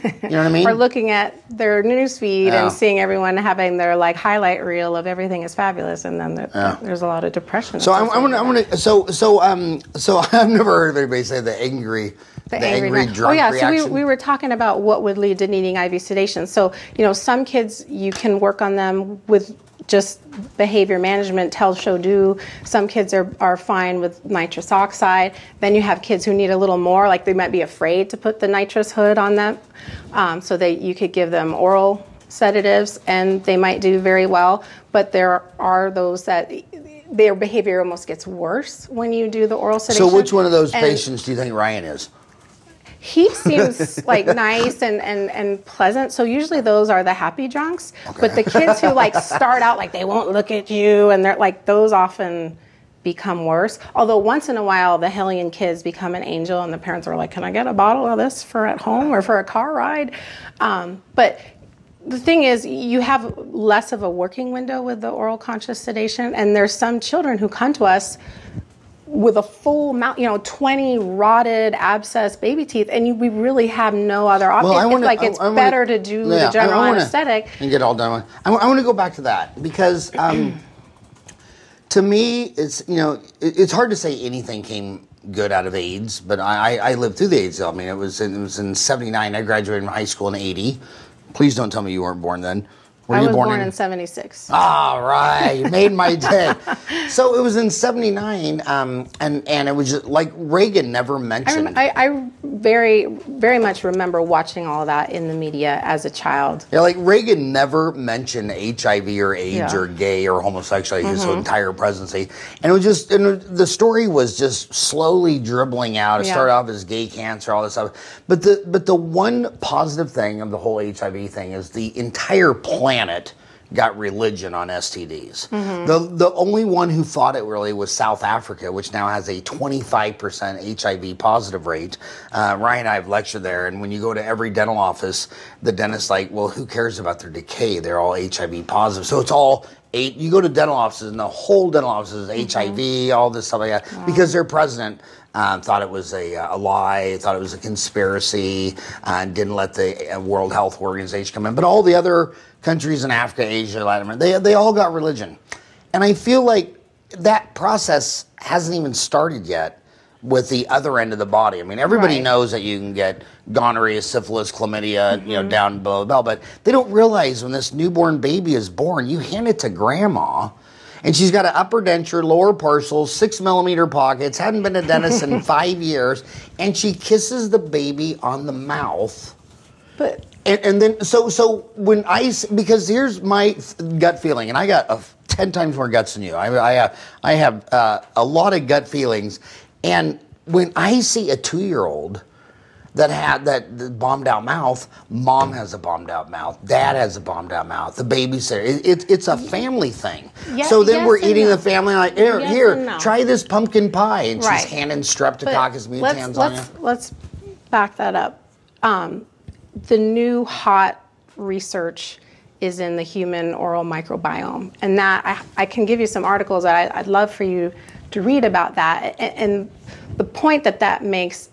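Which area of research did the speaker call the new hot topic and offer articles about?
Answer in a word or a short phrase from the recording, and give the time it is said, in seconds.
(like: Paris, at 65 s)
human oral microbiome, at 213 s.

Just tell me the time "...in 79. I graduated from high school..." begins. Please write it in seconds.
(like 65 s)
88 s.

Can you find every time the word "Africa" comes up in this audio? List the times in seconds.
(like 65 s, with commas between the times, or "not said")
128 s, 153 s.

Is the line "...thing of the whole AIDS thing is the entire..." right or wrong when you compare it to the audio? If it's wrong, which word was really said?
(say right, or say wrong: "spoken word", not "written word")
wrong: "HIV", not "AIDS".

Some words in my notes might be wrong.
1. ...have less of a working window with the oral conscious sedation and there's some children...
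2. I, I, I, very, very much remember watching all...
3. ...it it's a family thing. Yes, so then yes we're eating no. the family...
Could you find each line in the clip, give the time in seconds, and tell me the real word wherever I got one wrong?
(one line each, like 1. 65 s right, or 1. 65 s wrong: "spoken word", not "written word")
1. 63 s right
2. 101 s right
3. 198 s right.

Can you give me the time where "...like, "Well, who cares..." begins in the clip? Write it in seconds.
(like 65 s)
136 s.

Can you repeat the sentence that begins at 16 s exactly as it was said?
So you know, some kids you can work on them with just behavior management, tell, show, do.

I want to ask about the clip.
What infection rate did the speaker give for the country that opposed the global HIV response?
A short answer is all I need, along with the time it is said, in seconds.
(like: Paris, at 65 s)
25%, at 129 s.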